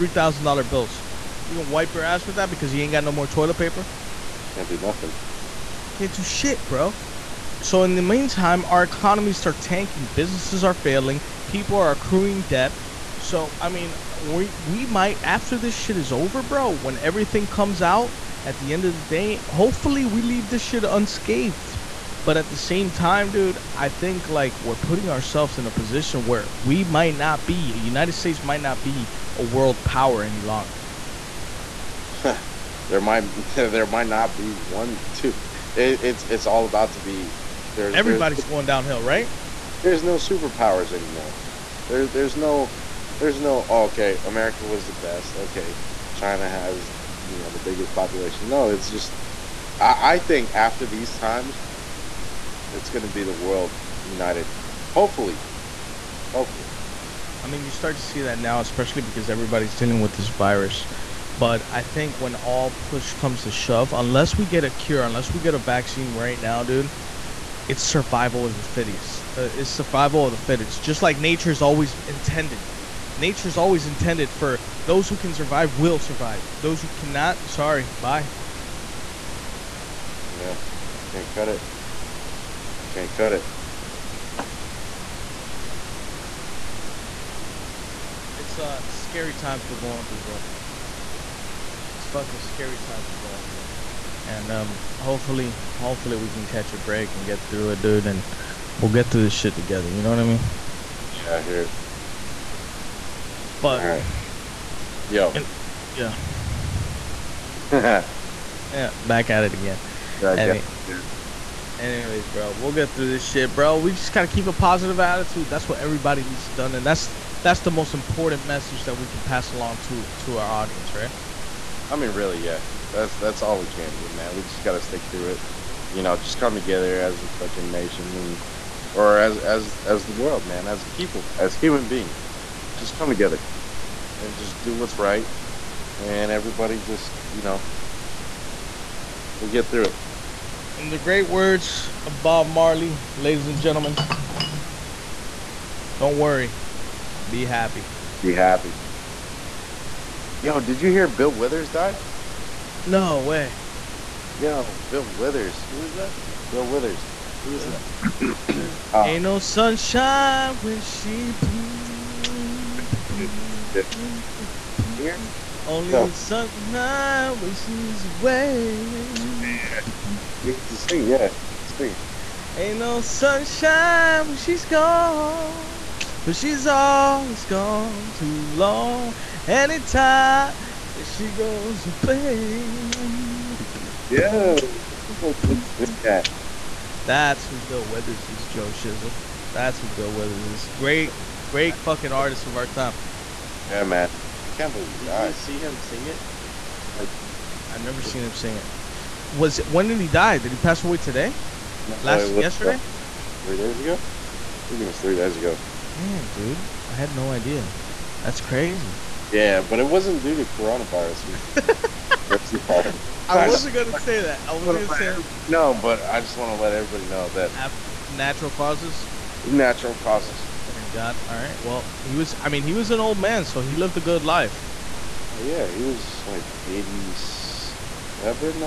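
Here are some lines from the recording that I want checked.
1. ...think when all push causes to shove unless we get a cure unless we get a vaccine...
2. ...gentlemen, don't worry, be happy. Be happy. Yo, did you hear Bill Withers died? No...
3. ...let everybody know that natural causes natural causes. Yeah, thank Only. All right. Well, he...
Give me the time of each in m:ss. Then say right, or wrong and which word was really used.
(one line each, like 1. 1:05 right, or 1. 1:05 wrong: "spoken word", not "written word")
1. 1:01 wrong: "comes", not "causes"
2. 2:23 right
3. 3:36 wrong: "God", not "Only".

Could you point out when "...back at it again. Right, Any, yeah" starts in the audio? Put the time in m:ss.
1:48.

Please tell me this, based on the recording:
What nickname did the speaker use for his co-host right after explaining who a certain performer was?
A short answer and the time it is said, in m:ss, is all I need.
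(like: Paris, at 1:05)
Joe Shizzle, at 3:08.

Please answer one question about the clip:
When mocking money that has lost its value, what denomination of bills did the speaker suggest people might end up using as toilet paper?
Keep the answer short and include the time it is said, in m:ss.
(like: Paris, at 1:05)
thousand dollar bills, at 0:00.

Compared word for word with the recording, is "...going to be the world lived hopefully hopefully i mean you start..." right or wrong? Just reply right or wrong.
wrong.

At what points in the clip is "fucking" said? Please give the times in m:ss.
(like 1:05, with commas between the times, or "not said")
1:32, 2:07, 3:11.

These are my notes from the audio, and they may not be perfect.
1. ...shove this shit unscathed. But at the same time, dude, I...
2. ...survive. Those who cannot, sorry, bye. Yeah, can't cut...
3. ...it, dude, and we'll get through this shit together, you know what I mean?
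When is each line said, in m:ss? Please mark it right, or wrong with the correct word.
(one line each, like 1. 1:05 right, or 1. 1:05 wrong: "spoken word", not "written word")
1. 0:20 wrong: "leave", not "shove"
2. 1:15 right
3. 1:37 right.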